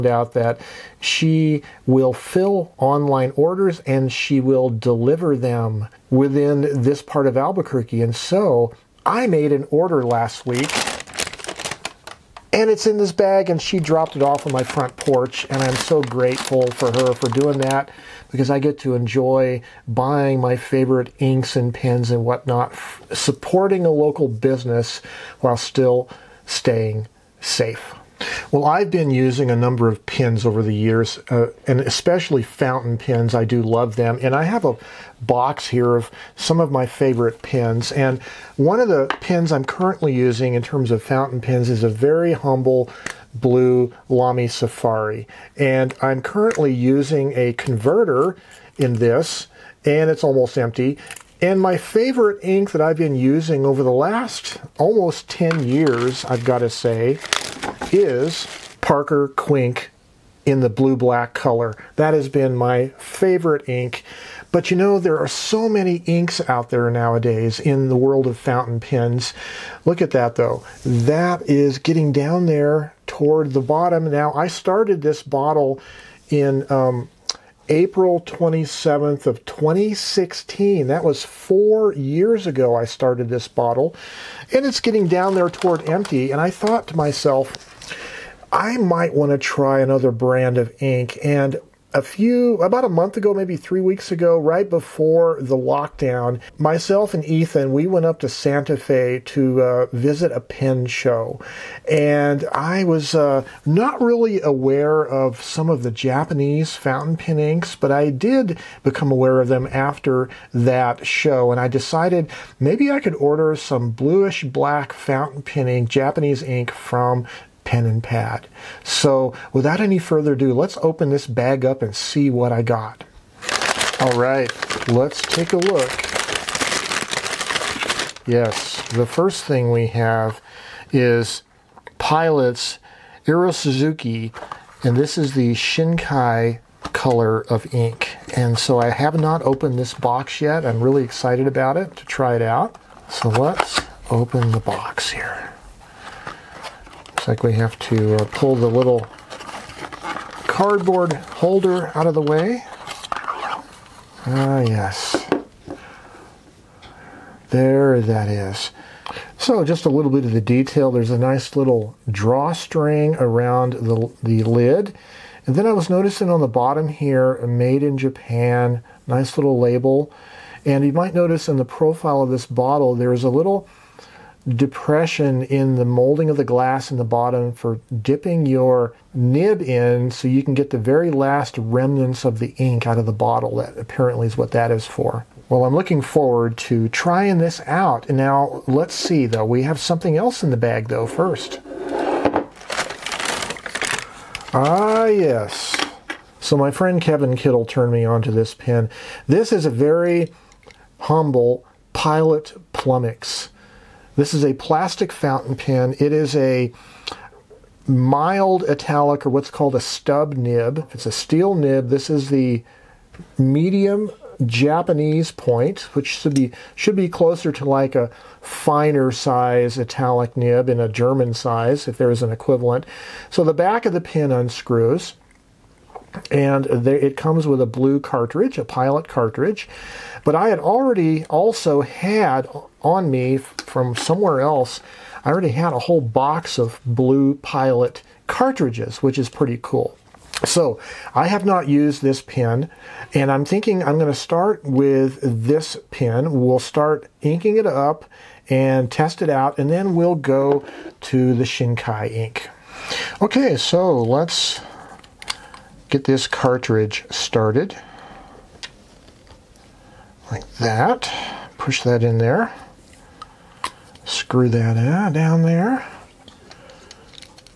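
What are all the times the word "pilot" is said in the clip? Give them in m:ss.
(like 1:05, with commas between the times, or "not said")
2:11, 3:21, 3:48, 3:57.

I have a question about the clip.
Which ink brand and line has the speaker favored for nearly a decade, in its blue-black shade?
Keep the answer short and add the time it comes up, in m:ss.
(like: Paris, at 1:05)
Parker Quink, at 0:58.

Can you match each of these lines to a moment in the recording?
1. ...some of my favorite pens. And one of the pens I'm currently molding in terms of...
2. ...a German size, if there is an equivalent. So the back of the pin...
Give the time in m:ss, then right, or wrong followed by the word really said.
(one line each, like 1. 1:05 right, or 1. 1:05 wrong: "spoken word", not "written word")
1. 0:36 wrong: "using", not "molding"
2. 3:40 right.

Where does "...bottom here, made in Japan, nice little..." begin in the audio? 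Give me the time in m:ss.
2:46.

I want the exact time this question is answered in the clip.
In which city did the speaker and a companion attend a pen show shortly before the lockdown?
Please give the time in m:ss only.
1:38.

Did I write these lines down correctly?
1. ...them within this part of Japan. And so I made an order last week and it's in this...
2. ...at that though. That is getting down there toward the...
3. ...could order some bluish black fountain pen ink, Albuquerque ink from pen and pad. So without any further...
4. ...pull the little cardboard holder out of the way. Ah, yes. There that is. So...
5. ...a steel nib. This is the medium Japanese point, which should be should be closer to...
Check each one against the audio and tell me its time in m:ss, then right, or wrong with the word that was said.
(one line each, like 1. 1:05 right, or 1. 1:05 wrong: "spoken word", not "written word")
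1. 0:05 wrong: "Albuquerque", not "Japan"
2. 1:09 right
3. 1:52 wrong: "Japanese", not "Albuquerque"
4. 2:28 right
5. 3:31 right.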